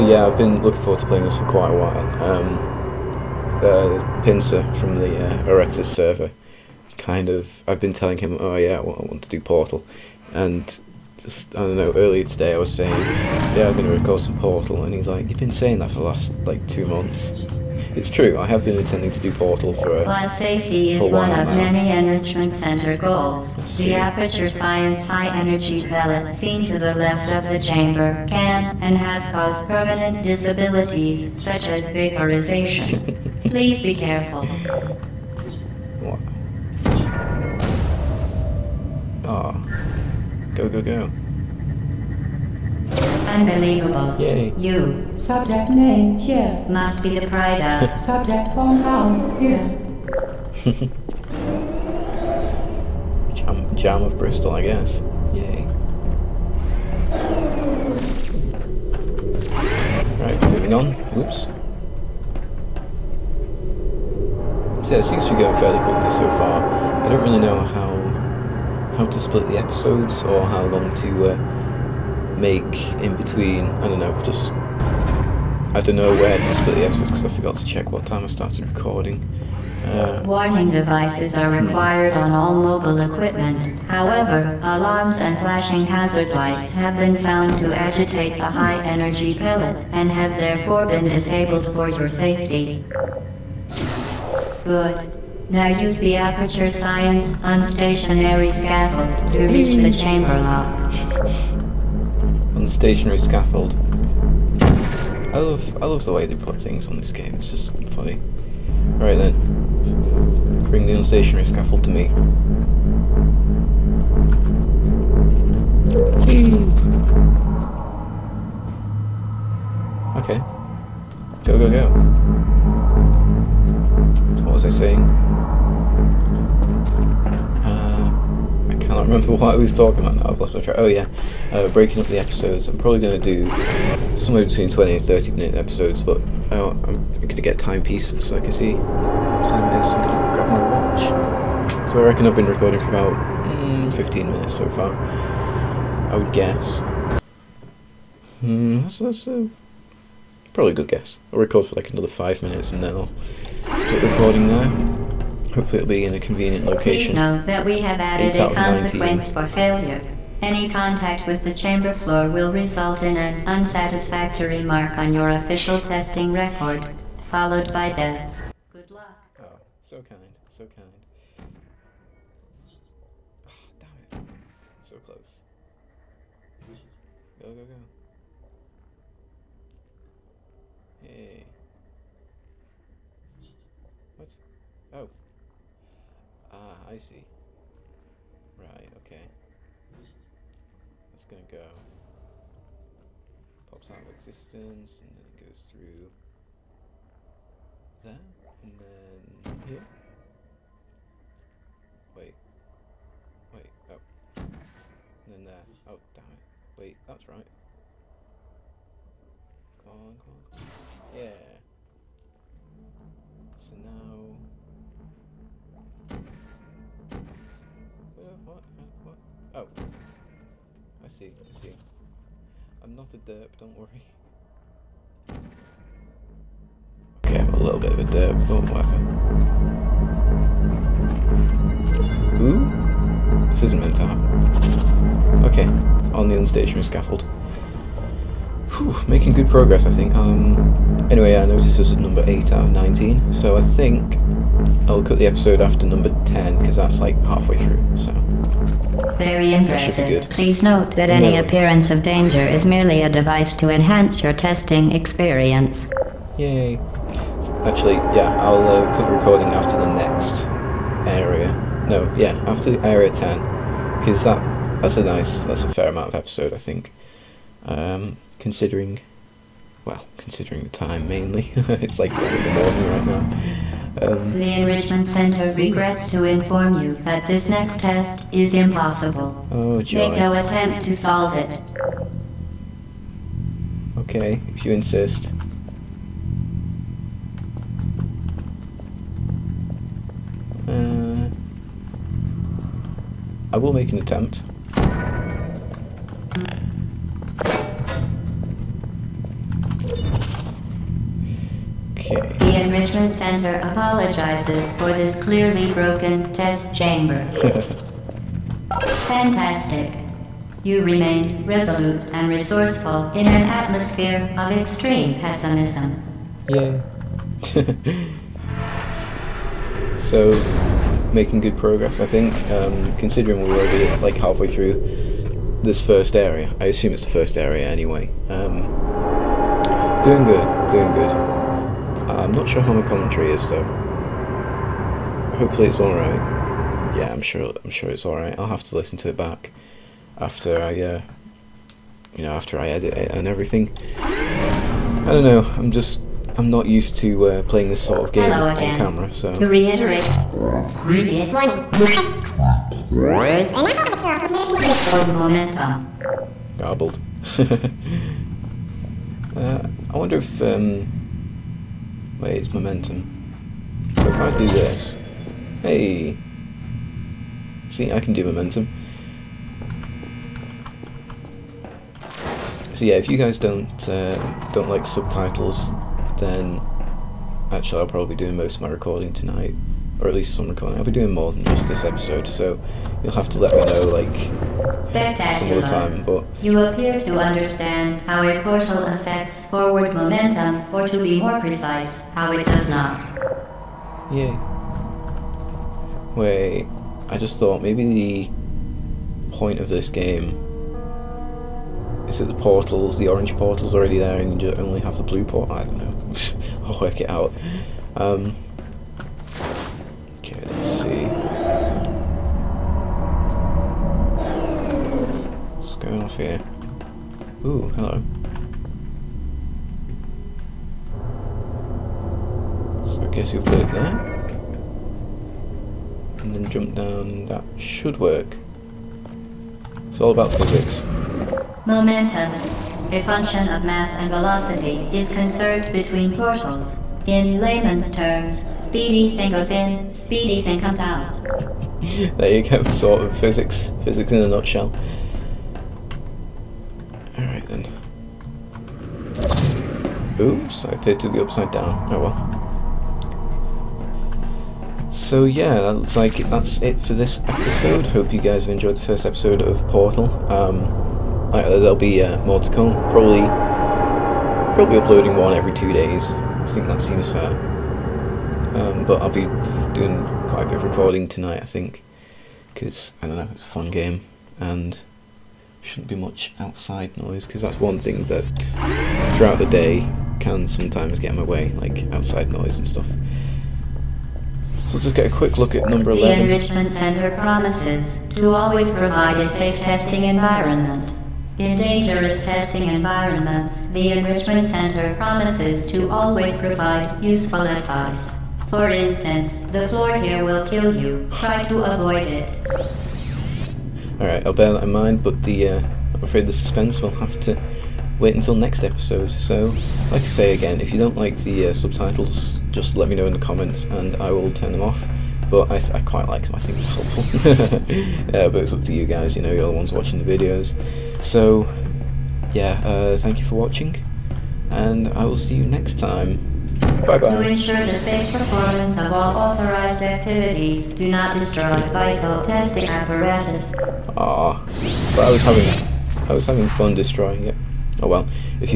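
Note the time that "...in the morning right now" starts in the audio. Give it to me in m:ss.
4:32.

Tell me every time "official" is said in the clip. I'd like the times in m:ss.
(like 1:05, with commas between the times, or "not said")
2:45.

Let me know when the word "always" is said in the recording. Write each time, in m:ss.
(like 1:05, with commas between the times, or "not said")
8:08, 8:15.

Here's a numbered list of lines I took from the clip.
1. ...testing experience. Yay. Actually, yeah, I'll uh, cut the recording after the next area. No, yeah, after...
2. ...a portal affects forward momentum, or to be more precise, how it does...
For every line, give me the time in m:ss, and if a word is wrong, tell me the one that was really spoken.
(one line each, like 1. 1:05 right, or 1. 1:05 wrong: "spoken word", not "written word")
1. 4:14 right
2. 6:28 right.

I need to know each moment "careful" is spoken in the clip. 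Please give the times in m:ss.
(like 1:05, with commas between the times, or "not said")
0:33.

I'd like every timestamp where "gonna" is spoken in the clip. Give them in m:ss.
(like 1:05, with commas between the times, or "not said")
3:11.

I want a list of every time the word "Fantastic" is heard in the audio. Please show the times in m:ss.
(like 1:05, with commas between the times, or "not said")
5:09.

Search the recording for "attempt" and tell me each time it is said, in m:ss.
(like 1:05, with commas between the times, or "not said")
4:40, 4:53.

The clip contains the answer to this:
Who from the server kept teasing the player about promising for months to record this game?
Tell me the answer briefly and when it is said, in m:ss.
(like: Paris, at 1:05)
Pincer, at 0:04.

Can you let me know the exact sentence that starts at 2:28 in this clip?
Hmm, that's, that's a probably a good guess.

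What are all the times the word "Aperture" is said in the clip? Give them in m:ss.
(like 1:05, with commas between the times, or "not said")
0:23, 1:36.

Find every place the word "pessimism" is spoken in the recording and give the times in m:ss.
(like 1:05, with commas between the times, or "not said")
5:15.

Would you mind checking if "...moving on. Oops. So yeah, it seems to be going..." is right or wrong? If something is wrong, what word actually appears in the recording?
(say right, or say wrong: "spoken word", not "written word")
right.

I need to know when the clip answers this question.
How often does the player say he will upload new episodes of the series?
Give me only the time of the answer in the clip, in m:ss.
7:45.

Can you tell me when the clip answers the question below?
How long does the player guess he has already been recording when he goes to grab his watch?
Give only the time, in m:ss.
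2:23.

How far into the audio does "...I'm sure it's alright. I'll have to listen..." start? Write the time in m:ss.
5:37.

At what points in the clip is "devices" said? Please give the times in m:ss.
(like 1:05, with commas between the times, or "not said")
1:20, 4:13.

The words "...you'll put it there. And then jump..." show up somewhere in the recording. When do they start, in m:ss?
7:03.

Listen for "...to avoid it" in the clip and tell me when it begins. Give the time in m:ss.
8:21.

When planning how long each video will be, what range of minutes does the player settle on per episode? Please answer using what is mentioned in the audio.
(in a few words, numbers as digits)
20 to 30 minutes.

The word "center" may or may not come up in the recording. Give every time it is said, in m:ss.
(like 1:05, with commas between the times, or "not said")
0:22, 4:35, 5:03, 8:06, 8:14.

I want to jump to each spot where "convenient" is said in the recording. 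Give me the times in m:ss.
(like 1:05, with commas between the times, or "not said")
2:36.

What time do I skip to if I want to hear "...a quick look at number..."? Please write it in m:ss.
8:05.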